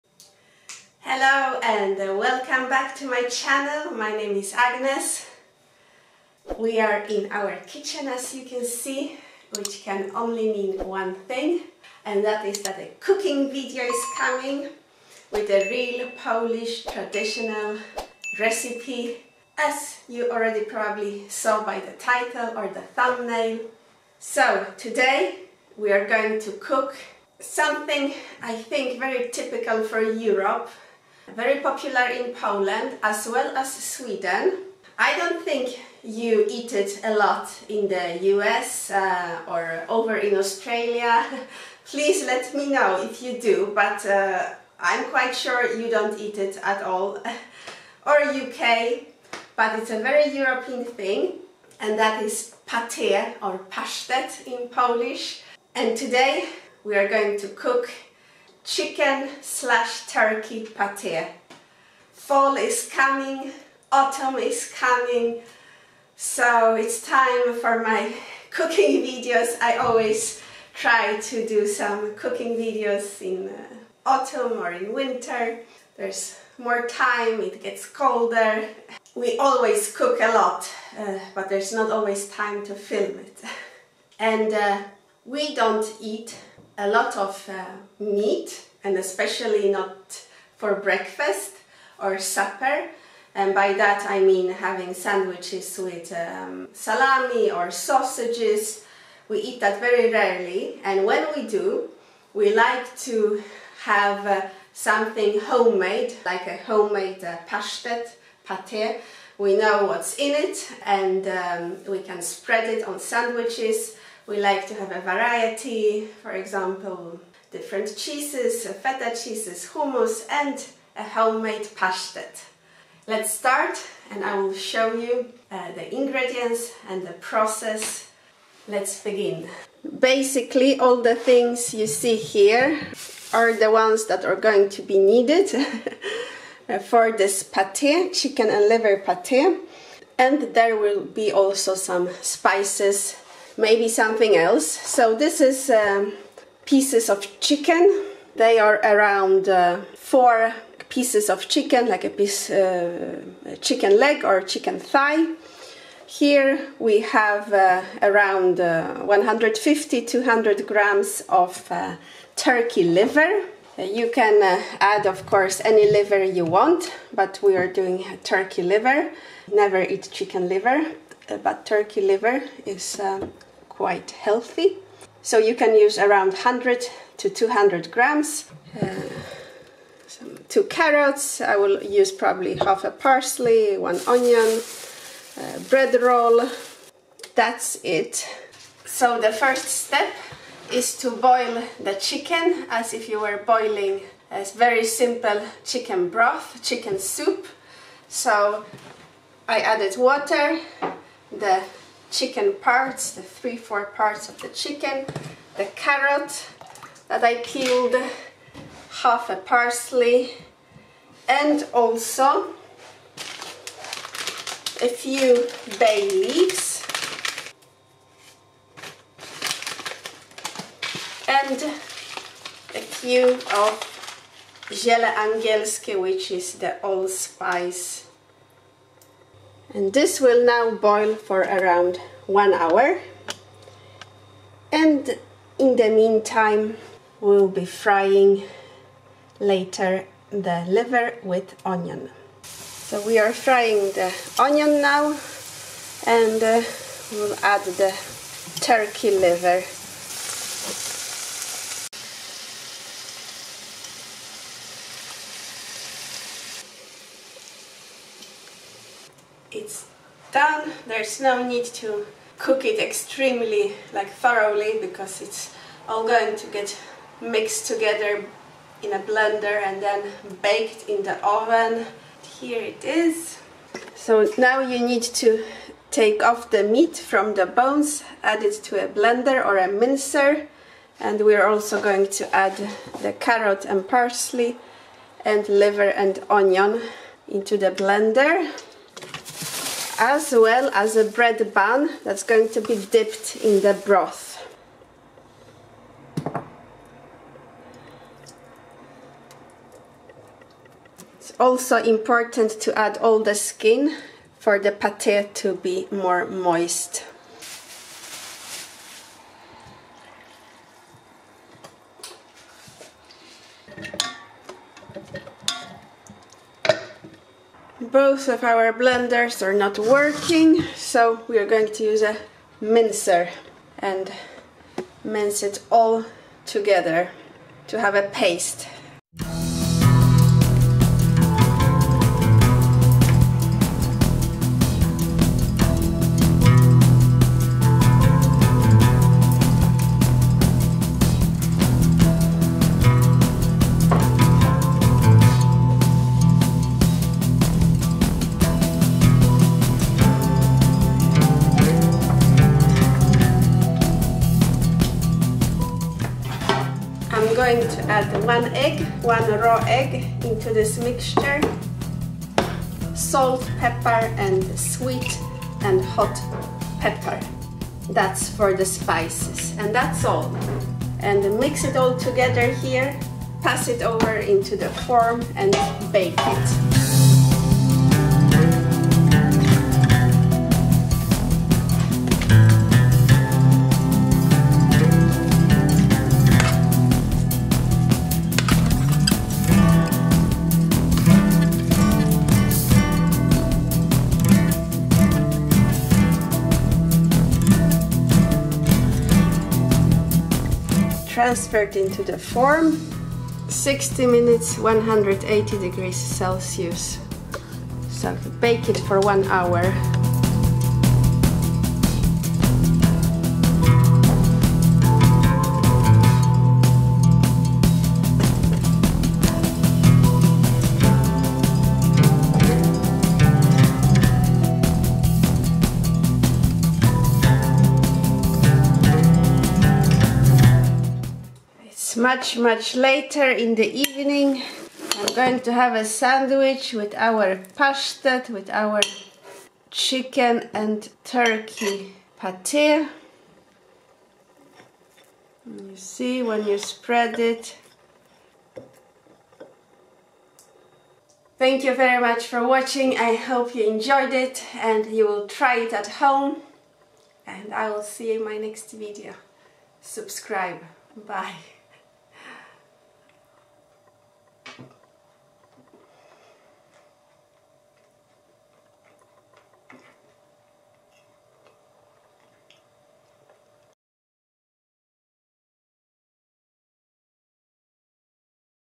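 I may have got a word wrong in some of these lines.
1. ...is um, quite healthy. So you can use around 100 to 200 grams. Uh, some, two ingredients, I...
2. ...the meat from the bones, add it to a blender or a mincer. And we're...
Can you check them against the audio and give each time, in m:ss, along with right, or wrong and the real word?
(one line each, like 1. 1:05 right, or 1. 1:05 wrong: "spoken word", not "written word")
1. 2:52 wrong: "carrots", not "ingredients"
2. 4:36 right.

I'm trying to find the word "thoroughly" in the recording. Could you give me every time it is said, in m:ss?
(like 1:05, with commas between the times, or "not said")
4:24.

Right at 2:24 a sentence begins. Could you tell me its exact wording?
So this is um, pieces of chicken.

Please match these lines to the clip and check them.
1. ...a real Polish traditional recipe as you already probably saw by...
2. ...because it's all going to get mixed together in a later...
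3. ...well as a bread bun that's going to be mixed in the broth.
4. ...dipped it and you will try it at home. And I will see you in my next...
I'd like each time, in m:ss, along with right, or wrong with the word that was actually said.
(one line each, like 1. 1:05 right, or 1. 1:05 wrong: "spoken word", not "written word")
1. 0:15 right
2. 4:24 wrong: "blender", not "later"
3. 4:50 wrong: "dipped", not "mixed"
4. 7:33 wrong: "enjoyed", not "dipped".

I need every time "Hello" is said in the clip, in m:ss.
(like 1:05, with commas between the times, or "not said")
0:01.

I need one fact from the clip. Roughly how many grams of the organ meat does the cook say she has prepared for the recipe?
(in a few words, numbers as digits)
150-200 grams.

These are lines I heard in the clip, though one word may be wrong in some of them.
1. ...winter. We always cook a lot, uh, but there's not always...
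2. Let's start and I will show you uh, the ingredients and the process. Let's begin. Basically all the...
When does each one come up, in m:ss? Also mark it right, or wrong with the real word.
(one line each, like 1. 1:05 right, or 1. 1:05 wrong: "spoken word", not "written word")
1. 1:17 wrong: "colder", not "winter"
2. 2:03 right.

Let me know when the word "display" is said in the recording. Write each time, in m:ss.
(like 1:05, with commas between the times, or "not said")
not said.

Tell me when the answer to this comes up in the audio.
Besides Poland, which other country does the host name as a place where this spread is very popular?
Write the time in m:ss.
0:33.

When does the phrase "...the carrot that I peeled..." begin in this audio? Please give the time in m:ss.
3:25.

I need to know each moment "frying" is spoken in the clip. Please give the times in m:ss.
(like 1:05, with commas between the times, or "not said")
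3:57, 4:03.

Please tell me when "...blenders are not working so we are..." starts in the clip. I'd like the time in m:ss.
5:18.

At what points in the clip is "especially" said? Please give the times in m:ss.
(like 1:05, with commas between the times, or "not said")
1:28.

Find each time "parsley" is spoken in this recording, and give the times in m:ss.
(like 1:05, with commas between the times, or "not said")
3:02, 3:29, 4:43.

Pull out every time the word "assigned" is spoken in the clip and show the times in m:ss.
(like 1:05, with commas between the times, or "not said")
not said.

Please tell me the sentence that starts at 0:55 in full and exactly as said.
And today we are going to cook chicken slash turkey pate.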